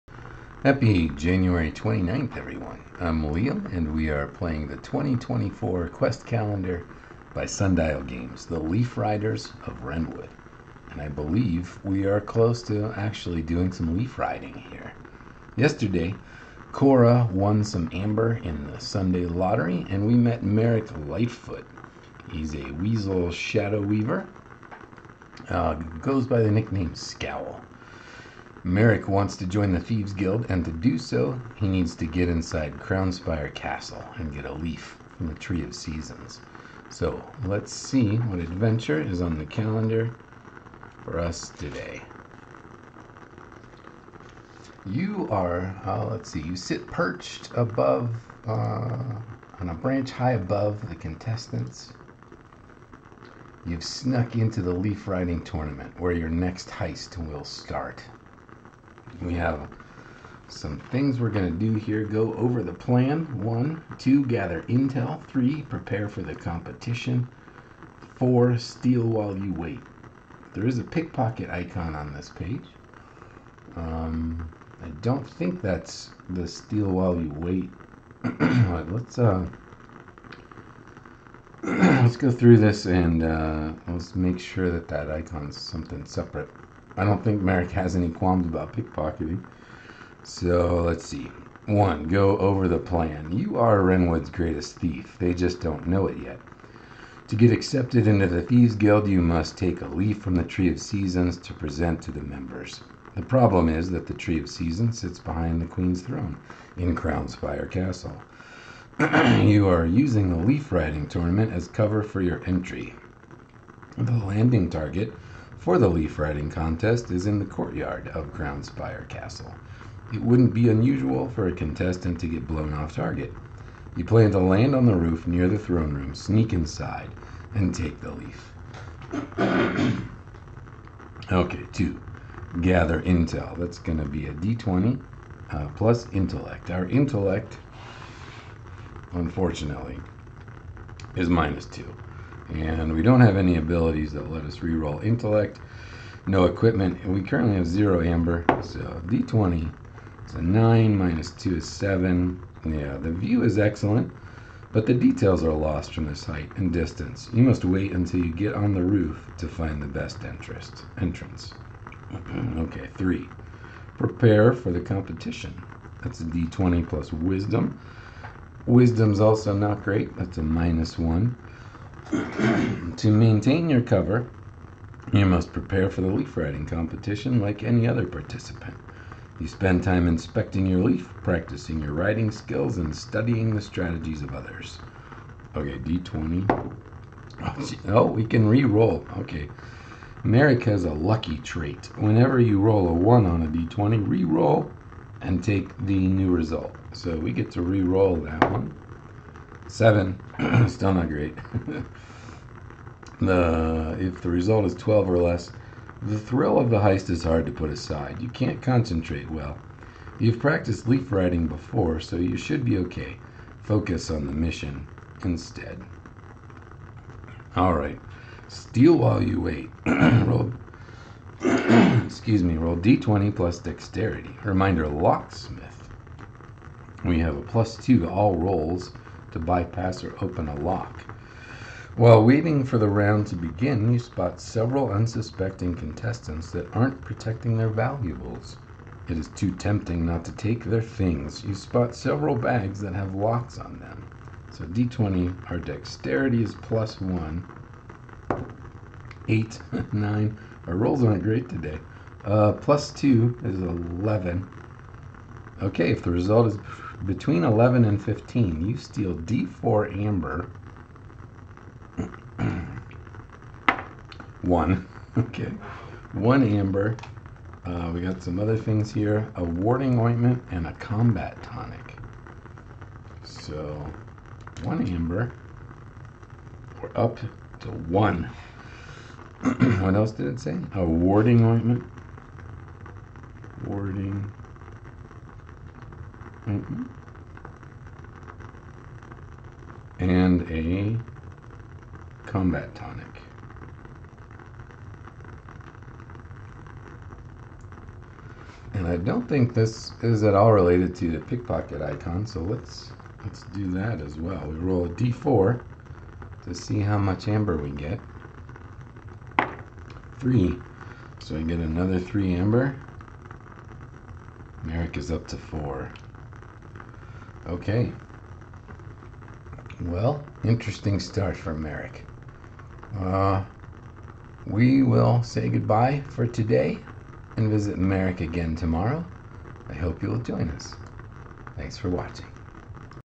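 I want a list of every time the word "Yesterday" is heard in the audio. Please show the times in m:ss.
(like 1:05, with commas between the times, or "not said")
0:15.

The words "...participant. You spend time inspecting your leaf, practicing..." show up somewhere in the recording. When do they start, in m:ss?
2:58.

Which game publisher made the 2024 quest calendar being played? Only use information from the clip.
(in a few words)
Sundial Games.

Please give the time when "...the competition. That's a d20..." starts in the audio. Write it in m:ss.
2:44.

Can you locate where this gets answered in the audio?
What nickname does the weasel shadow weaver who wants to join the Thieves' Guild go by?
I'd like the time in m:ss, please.
0:26.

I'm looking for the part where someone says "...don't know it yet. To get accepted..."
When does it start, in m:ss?
1:35.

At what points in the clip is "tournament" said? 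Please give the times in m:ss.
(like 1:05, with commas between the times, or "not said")
0:55, 1:51.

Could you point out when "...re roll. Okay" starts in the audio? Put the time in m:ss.
3:08.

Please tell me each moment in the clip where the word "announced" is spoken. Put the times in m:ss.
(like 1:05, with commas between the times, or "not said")
not said.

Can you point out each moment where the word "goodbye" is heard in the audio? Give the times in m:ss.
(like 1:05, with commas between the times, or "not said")
5:25.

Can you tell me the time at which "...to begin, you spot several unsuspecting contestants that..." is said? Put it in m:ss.
3:53.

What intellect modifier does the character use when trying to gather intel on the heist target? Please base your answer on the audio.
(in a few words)
-2.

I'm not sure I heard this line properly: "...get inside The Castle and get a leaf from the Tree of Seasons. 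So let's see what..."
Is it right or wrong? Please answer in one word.
wrong.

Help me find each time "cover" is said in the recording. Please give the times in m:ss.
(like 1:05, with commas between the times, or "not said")
1:51, 2:53.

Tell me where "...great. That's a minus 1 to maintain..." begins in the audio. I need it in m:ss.
2:49.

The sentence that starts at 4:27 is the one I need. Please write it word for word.
Uh, we got some other things here.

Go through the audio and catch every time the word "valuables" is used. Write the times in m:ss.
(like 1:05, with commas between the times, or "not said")
3:57.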